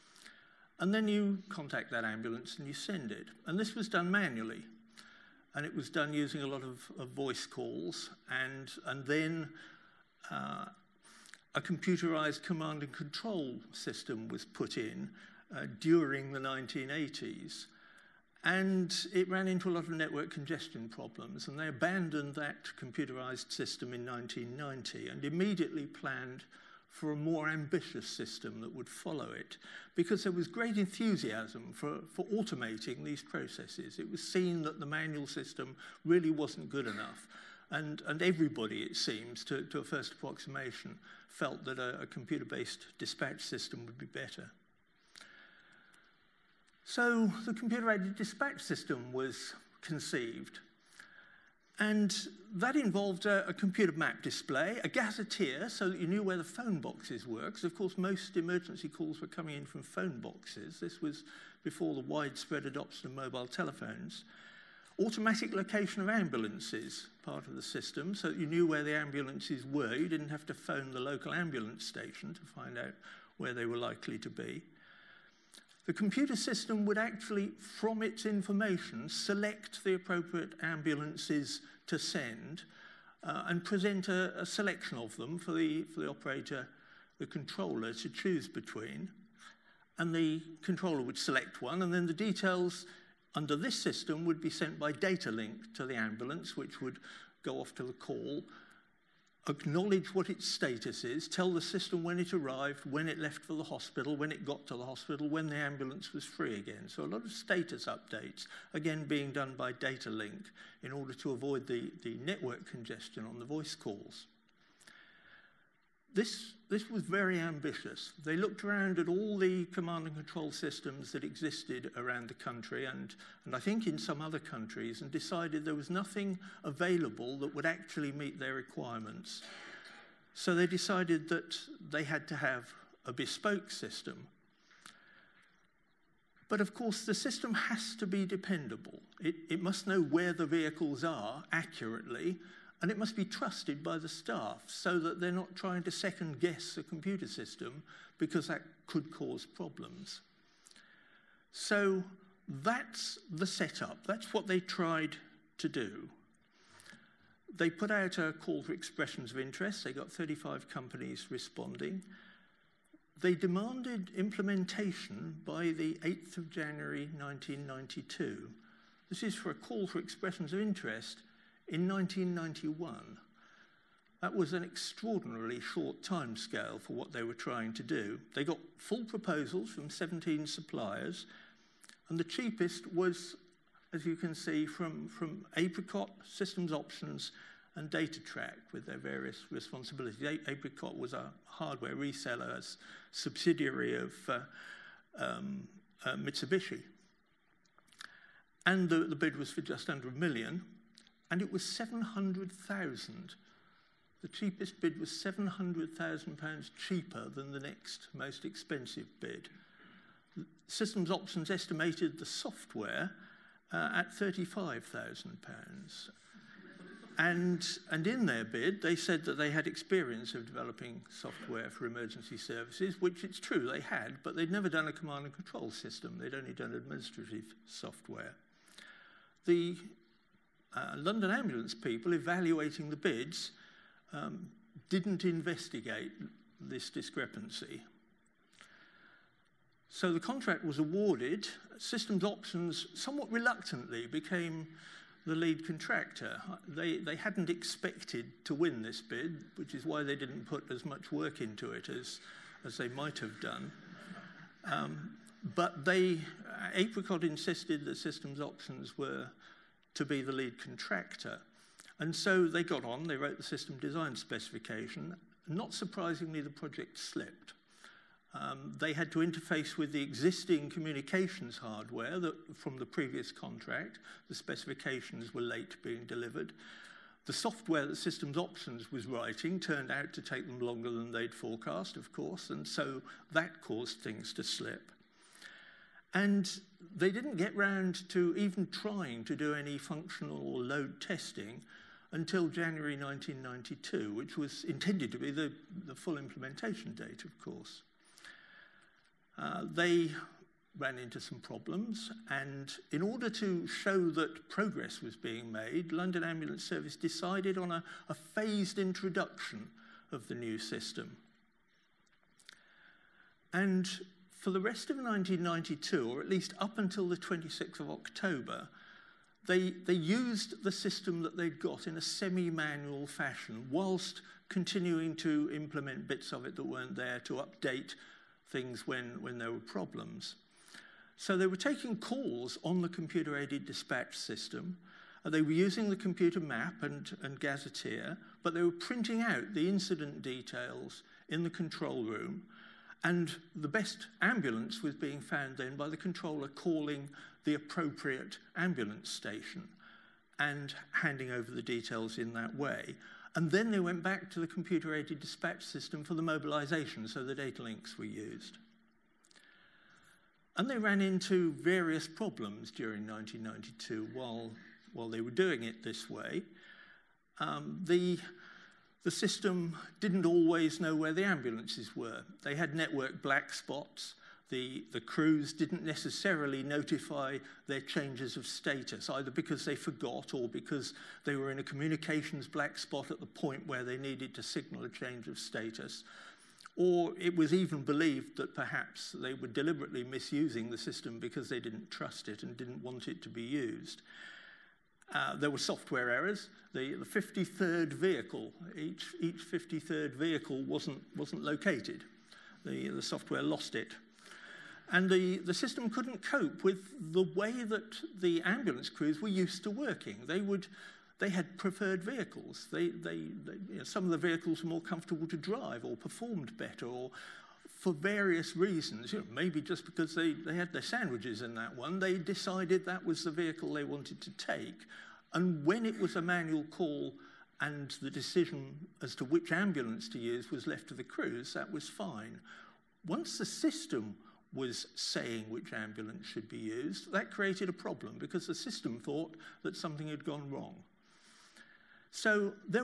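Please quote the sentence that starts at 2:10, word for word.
So they decided that they had to have a bespoke system.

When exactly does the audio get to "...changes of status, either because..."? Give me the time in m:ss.
6:17.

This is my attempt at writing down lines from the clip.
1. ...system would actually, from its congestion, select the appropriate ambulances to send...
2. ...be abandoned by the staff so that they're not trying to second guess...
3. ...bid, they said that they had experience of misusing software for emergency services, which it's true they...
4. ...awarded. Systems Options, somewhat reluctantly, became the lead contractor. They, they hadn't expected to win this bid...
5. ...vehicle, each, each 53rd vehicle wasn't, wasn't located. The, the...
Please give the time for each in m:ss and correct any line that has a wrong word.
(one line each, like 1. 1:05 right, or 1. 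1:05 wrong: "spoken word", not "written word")
1. 1:16 wrong: "information", not "congestion"
2. 2:23 wrong: "trusted", not "abandoned"
3. 3:38 wrong: "developing", not "misusing"
4. 4:00 right
5. 6:37 right.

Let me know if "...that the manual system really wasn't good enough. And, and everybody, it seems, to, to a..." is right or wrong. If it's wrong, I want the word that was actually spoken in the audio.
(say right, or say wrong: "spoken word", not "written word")
right.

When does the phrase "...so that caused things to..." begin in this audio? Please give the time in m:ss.
4:42.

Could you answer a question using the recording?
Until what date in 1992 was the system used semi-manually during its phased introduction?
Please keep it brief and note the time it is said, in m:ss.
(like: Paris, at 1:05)
26th of October, at 5:17.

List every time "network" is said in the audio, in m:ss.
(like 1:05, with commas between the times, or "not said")
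0:19, 1:52, 6:12.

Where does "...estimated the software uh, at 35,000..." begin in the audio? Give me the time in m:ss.
3:31.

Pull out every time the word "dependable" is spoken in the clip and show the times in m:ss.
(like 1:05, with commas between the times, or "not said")
2:18.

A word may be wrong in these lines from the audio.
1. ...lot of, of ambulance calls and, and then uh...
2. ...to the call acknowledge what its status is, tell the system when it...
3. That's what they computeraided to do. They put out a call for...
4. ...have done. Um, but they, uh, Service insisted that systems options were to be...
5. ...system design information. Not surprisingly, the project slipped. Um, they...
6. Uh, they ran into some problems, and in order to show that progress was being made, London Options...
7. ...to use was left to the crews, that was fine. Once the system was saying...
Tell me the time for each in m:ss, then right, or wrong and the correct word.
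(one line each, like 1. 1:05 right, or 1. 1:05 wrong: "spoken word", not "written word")
1. 0:06 wrong: "voice", not "ambulance"
2. 1:37 right
3. 2:34 wrong: "tried", not "computeraided"
4. 4:13 wrong: "Apricot", not "Service"
5. 4:23 wrong: "specification", not "information"
6. 4:59 wrong: "Ambulance", not "Options"
7. 7:10 right.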